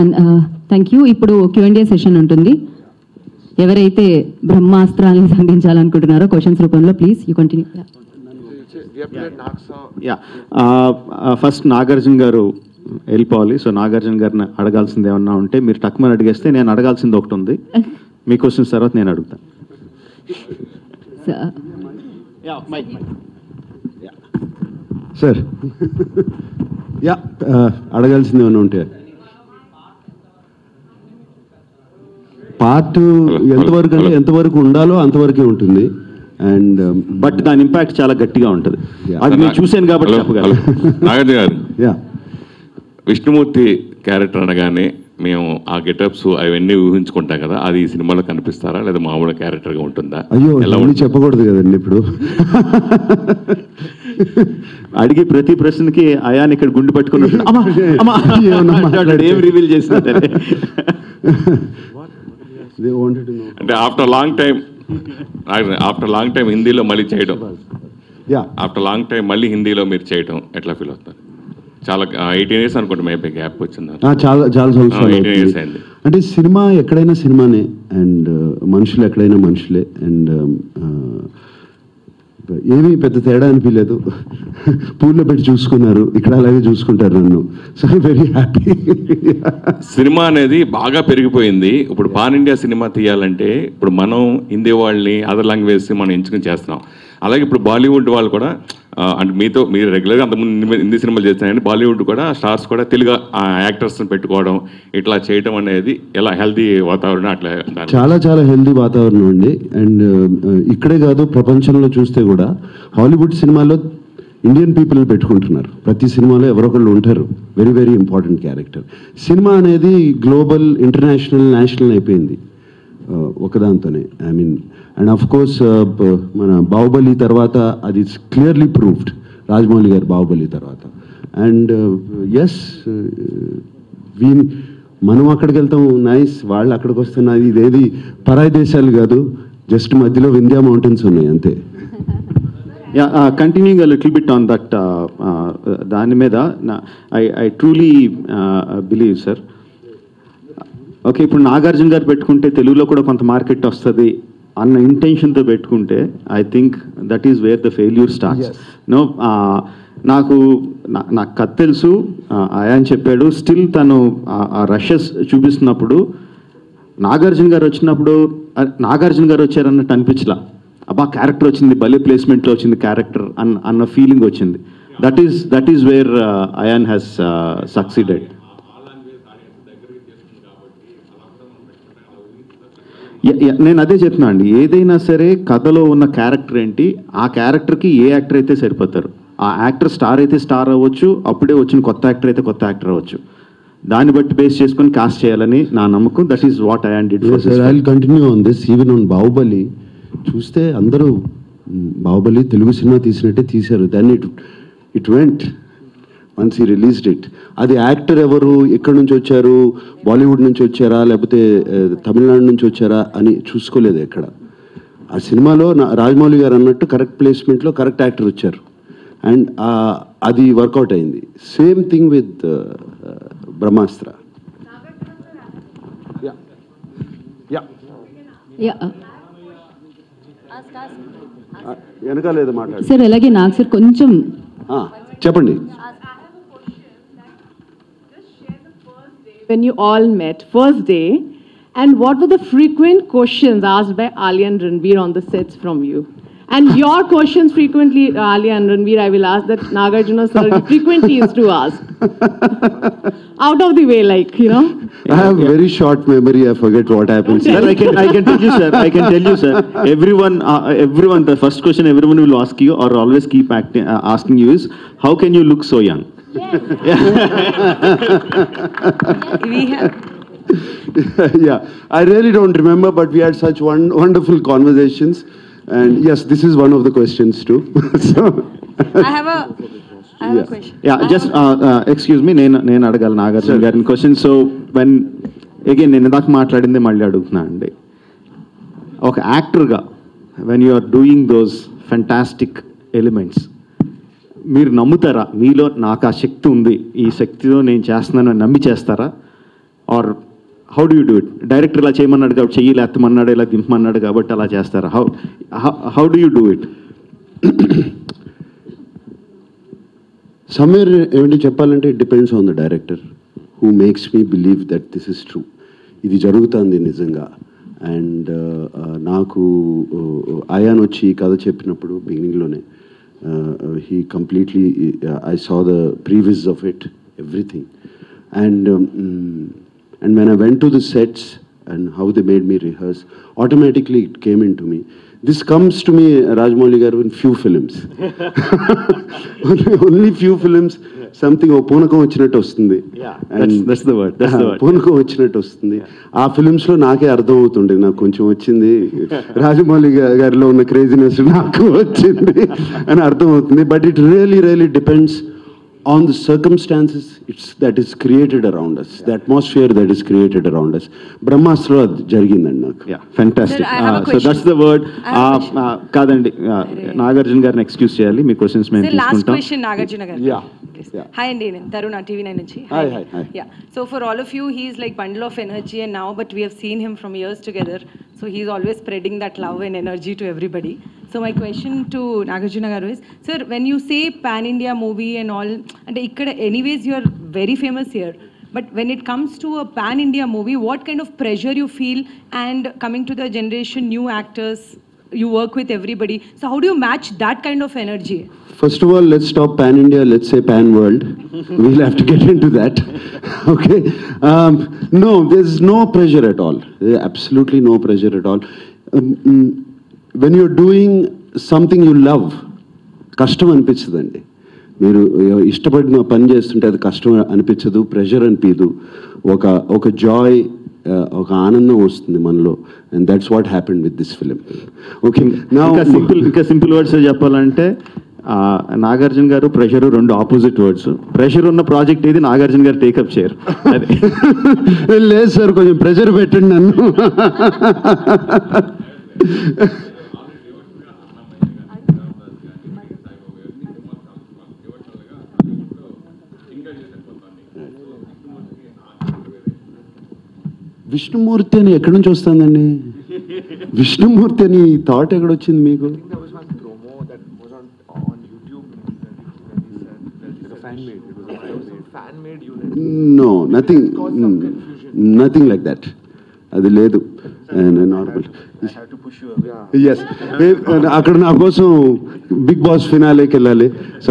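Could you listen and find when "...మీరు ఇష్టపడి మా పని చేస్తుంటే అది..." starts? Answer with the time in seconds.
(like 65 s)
414 s.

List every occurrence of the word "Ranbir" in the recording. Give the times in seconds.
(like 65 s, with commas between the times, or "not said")
244 s, 248 s.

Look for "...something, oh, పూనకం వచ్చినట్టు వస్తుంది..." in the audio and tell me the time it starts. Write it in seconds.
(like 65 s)
341 s.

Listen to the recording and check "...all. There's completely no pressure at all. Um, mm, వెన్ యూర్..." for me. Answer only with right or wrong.
wrong.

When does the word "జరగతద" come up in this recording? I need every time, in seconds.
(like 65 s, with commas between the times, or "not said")
316 s.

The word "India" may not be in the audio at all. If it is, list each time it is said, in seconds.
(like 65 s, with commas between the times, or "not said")
384 s, 389 s, 399 s.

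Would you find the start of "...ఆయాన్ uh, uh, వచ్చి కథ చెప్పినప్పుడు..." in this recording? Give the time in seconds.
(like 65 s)
320 s.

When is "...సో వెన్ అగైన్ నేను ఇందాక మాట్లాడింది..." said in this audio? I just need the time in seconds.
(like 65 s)
284 s.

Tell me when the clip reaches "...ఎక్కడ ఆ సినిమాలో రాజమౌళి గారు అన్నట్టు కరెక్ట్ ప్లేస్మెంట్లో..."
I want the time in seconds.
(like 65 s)
214 s.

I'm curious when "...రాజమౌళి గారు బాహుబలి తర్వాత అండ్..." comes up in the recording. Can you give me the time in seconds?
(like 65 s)
129 s.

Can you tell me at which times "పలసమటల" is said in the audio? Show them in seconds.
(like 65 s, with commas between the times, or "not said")
172 s, 217 s.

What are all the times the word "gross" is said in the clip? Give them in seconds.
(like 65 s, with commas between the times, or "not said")
not said.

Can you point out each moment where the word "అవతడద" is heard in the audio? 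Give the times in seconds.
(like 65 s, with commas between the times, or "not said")
347 s.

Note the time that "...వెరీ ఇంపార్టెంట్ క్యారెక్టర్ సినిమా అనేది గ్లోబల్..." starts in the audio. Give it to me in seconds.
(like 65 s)
117 s.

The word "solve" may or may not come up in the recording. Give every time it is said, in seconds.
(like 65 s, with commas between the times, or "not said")
not said.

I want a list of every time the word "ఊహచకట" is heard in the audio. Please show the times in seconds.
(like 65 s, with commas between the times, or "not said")
46 s.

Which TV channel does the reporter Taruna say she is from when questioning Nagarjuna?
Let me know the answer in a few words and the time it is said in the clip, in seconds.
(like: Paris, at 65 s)
TV9, at 372 s.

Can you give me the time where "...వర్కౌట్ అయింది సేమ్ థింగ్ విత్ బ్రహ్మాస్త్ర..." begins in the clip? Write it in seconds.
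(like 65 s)
220 s.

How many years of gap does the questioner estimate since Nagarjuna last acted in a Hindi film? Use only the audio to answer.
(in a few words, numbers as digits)
18.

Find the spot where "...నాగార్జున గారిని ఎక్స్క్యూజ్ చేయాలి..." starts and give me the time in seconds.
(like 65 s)
367 s.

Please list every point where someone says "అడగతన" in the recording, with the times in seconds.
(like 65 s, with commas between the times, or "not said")
19 s.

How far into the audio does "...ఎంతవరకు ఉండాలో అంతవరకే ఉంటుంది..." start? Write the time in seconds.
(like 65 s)
34 s.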